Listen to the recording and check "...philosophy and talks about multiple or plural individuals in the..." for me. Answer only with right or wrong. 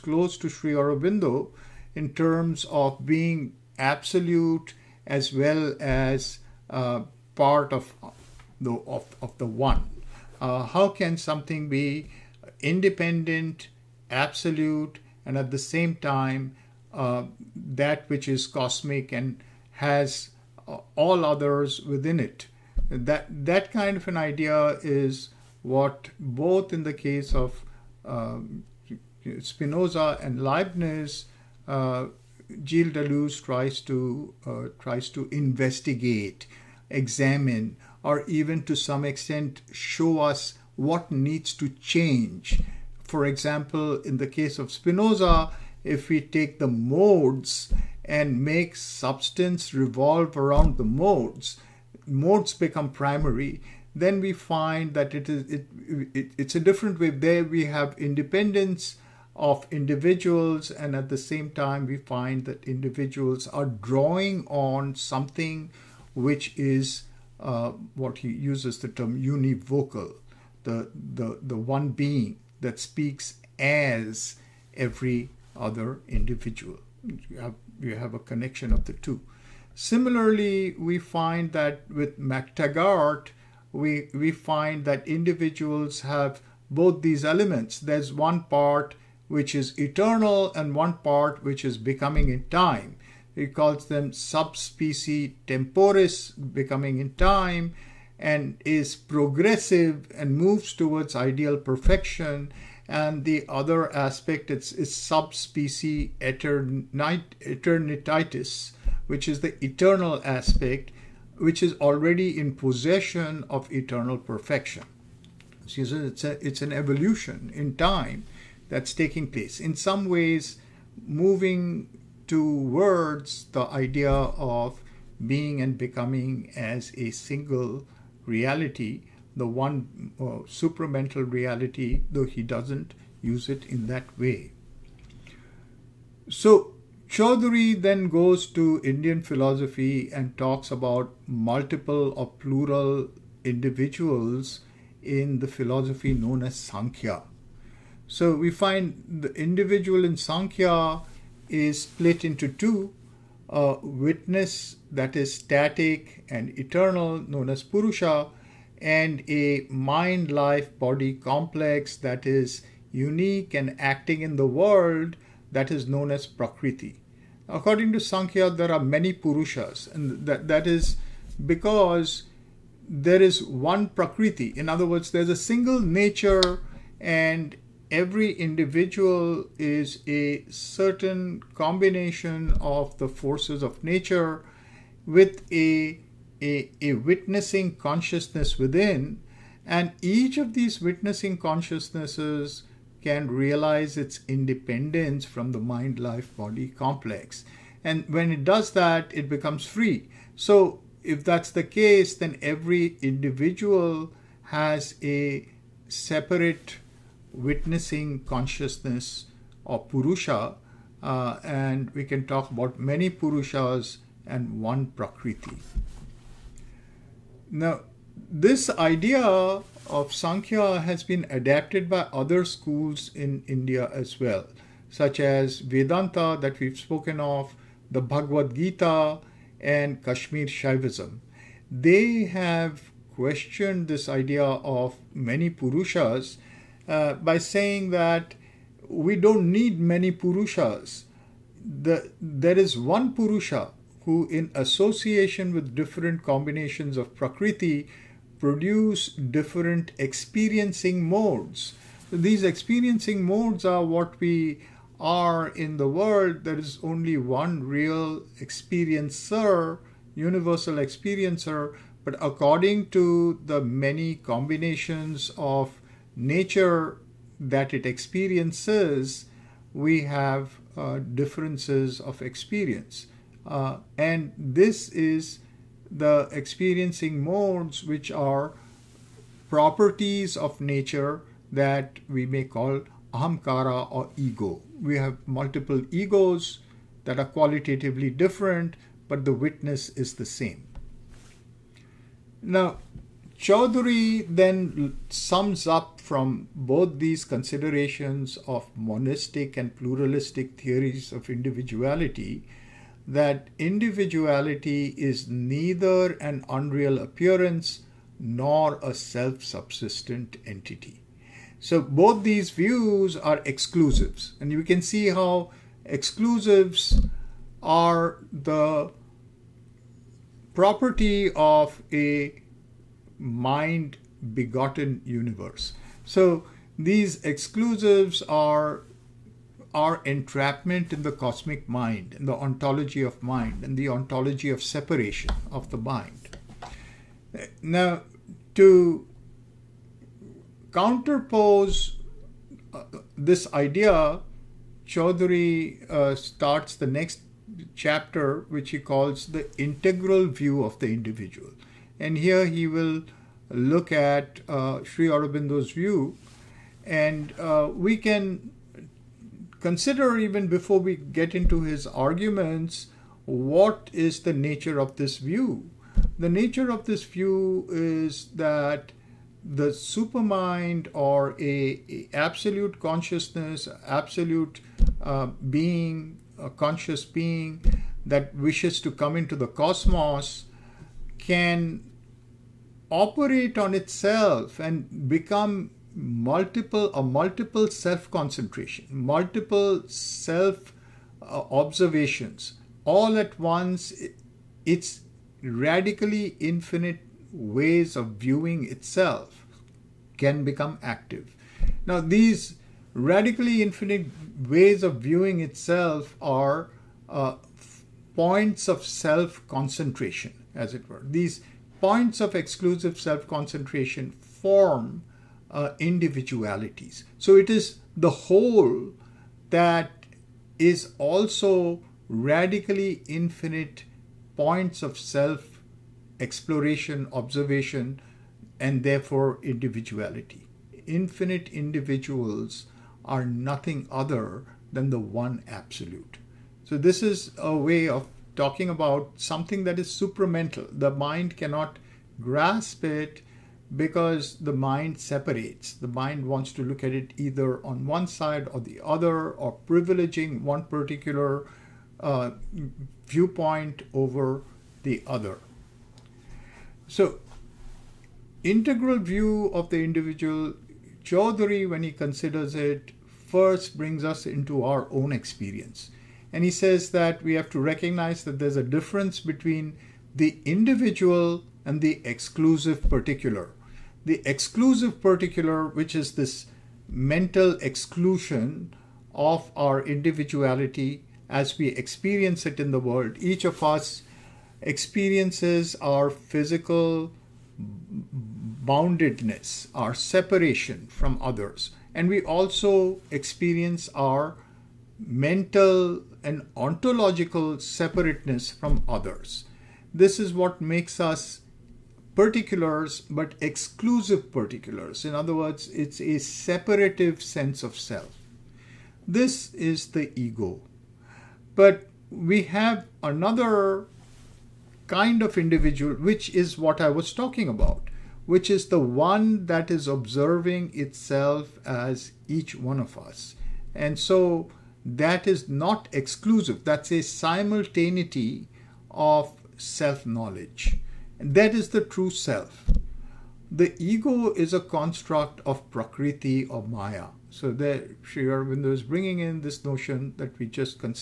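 right.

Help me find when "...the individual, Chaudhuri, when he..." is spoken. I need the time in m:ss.
7:39.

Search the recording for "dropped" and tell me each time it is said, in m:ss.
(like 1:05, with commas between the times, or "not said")
not said.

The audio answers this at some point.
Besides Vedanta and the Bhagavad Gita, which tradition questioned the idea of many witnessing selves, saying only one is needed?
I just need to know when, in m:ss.
3:50.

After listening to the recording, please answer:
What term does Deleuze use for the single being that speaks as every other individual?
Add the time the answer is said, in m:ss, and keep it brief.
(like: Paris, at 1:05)
univocal, at 1:09.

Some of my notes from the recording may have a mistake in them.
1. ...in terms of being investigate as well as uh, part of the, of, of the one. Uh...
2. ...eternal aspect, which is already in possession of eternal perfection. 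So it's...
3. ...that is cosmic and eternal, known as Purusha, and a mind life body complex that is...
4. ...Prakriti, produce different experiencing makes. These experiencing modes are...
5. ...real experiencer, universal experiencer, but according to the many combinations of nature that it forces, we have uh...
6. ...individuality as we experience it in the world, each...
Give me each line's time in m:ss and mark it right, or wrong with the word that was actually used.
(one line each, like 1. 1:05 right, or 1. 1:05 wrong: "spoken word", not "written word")
1. 0:01 wrong: "absolute", not "investigate"
2. 1:49 right
3. 2:34 wrong: "static", not "cosmic"
4. 4:07 wrong: "modes", not "makes"
5. 4:17 wrong: "experiences", not "forces"
6. 7:59 right.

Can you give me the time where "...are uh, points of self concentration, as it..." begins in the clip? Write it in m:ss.
6:46.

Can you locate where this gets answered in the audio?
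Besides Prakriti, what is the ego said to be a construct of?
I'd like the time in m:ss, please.
8:56.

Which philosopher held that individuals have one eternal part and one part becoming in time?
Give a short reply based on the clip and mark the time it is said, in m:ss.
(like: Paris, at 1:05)
McTaggart, at 1:22.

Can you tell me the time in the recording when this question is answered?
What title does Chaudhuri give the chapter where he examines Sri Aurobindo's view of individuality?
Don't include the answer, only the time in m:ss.
5:49.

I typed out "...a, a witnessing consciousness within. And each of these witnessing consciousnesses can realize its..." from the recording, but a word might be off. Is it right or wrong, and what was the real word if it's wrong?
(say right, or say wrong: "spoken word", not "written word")
right.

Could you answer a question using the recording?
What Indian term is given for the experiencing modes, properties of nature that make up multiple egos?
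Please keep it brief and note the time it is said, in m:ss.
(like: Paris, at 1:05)
ahamkara, at 4:43.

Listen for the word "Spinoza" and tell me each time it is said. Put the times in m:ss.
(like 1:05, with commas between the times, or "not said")
0:29, 0:44.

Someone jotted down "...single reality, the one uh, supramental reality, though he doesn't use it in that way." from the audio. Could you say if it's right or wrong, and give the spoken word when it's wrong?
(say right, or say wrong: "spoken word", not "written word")
right.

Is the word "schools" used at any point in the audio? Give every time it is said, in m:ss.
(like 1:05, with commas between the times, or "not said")
3:42.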